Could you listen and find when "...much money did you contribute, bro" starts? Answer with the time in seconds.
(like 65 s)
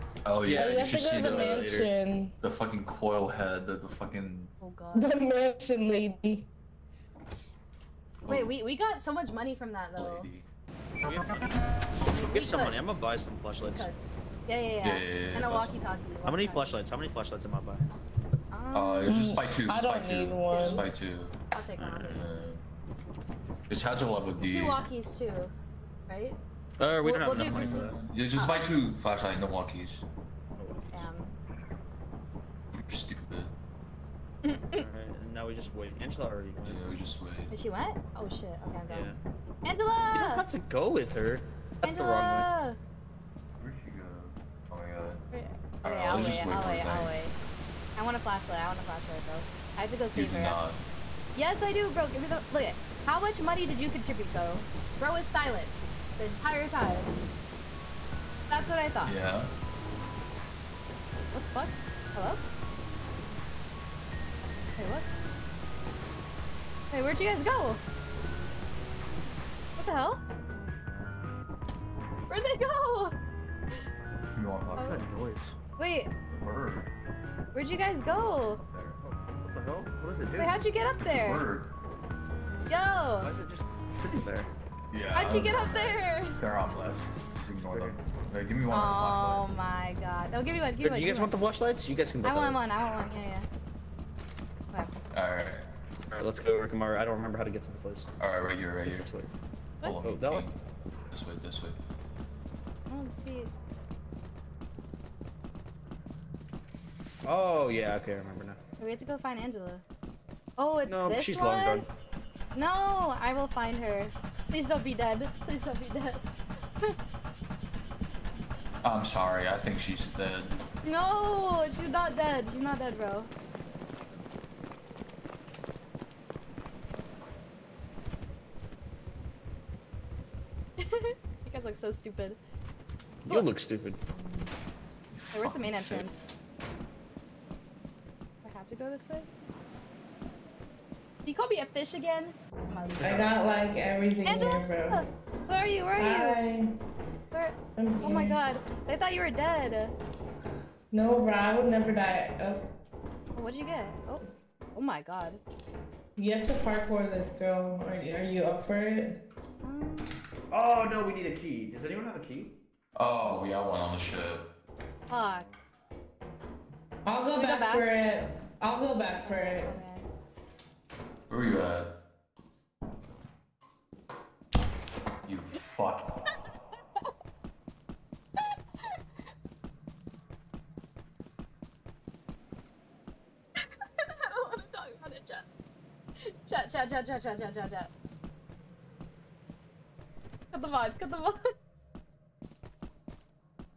53 s.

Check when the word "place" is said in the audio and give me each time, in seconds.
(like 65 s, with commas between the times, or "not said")
97 s.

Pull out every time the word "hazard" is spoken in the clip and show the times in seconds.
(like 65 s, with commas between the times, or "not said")
24 s.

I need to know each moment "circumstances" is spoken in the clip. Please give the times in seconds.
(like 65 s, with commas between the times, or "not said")
not said.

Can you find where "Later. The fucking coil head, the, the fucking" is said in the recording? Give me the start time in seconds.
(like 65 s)
2 s.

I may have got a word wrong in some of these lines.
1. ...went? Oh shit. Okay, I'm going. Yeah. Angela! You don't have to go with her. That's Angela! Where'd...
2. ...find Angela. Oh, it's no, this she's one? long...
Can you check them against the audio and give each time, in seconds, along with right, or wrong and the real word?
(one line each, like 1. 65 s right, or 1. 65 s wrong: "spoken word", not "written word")
1. 37 s right
2. 109 s right.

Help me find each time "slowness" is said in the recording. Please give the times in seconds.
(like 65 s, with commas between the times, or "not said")
not said.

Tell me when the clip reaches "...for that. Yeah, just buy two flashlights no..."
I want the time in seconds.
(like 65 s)
27 s.